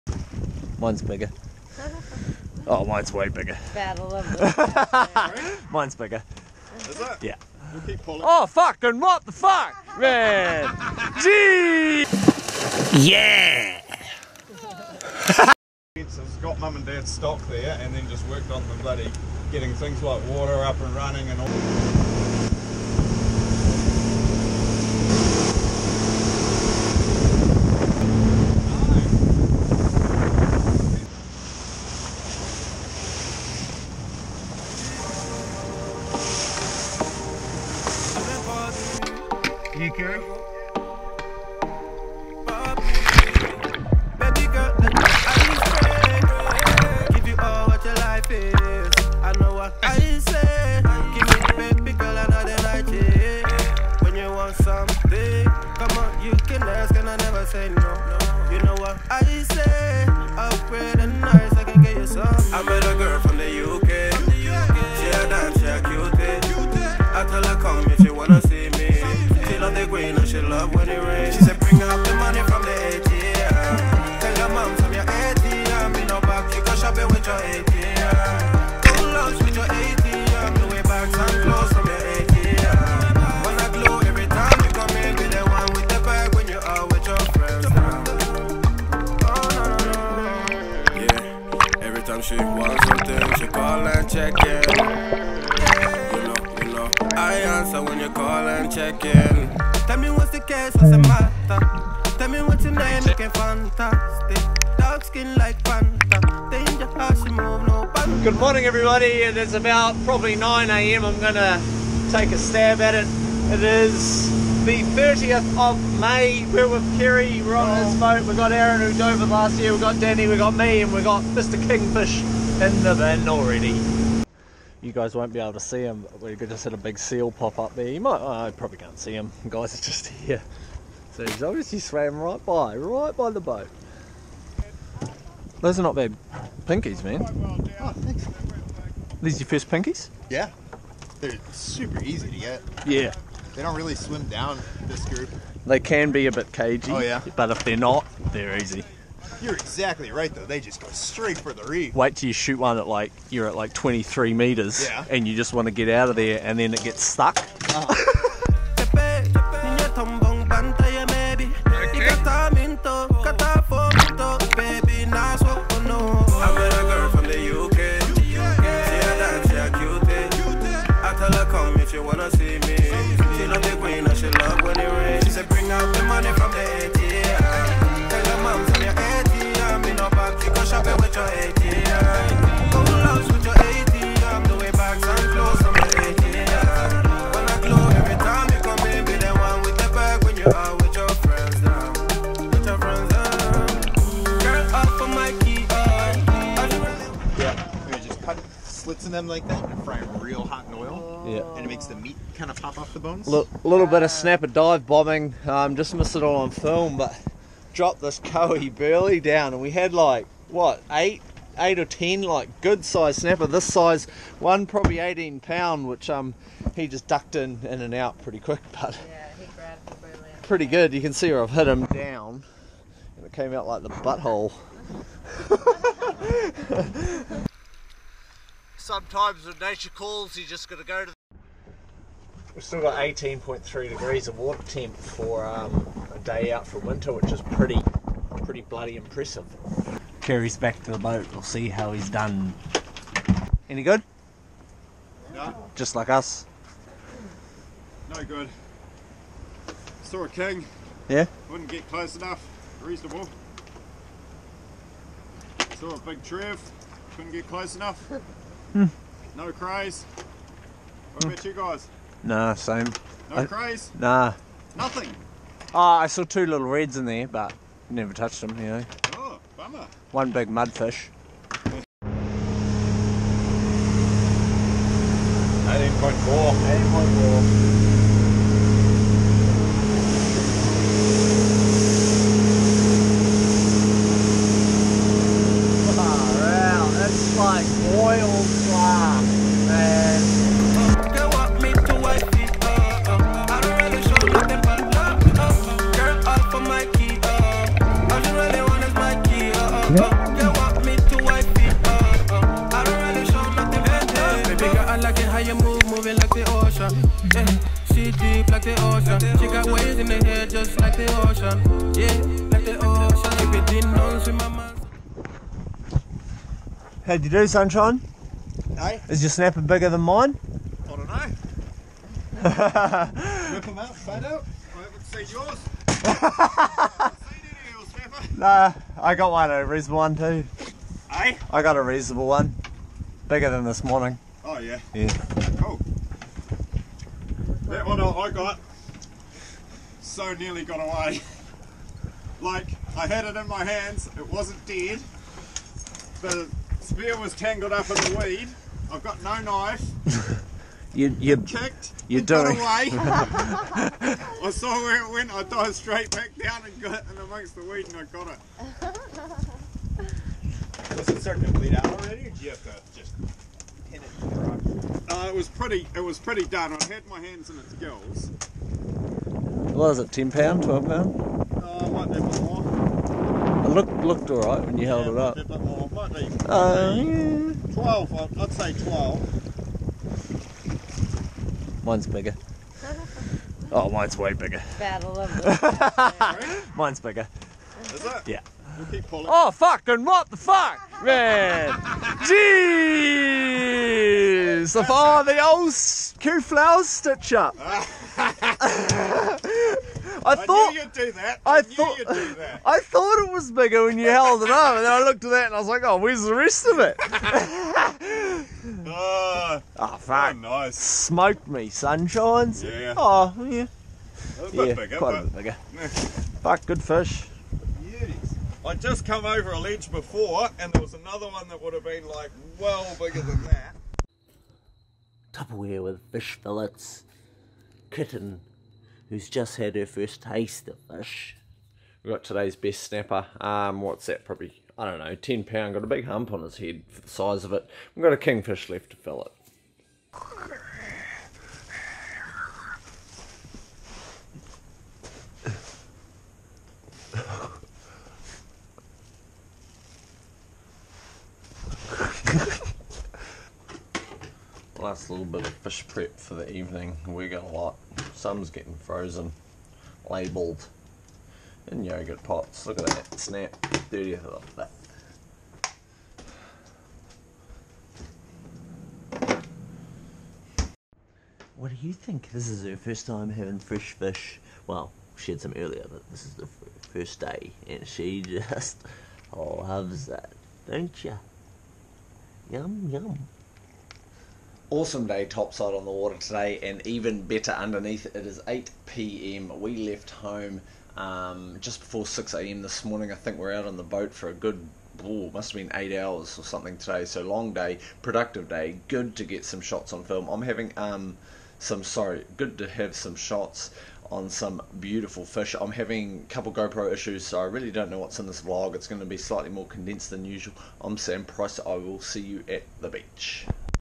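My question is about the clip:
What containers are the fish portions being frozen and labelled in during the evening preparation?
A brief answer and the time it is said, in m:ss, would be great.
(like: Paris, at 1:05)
yogurt pots, at 7:41.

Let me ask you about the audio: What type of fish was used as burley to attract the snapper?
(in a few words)
kahawai.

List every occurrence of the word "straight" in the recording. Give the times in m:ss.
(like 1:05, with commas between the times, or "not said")
2:30, 5:55.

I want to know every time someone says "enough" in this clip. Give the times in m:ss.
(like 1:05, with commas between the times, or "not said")
4:12, 4:17.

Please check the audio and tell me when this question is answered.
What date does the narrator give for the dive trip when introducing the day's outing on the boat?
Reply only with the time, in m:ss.
1:54.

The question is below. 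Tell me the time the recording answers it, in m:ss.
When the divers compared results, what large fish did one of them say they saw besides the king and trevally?
4:30.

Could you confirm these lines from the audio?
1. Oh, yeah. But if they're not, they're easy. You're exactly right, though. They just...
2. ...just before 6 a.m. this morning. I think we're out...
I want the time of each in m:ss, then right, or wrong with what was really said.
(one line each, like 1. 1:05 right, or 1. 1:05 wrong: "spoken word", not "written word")
1. 2:26 right
2. 8:11 right.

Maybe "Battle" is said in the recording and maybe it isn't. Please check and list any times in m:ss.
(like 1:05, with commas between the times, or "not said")
0:03, 6:24.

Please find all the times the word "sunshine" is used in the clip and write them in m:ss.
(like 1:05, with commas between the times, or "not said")
5:17, 6:51.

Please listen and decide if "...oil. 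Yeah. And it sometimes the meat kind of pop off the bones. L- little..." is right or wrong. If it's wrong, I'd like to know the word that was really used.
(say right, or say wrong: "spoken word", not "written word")
wrong: "makes", not "sometimes".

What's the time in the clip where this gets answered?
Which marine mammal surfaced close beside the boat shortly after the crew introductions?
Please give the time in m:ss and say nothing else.
2:06.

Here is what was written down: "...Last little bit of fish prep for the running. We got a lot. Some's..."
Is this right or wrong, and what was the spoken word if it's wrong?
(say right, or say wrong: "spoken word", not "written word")
wrong: "evening", not "running".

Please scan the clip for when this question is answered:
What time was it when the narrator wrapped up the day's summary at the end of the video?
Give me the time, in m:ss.
8:08.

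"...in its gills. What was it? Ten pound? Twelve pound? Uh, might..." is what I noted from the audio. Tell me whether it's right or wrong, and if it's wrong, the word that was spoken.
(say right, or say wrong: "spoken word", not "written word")
right.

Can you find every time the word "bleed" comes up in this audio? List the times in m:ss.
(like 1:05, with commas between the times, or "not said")
6:01.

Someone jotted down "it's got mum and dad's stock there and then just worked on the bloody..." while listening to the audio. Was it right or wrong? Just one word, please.
right.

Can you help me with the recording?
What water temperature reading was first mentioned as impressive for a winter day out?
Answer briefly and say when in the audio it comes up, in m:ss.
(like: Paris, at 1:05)
18.3 degrees, at 3:52.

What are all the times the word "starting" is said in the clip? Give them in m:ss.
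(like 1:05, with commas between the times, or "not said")
6:01.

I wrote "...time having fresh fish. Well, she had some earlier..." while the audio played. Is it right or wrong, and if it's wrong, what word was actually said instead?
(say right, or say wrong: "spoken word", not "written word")
right.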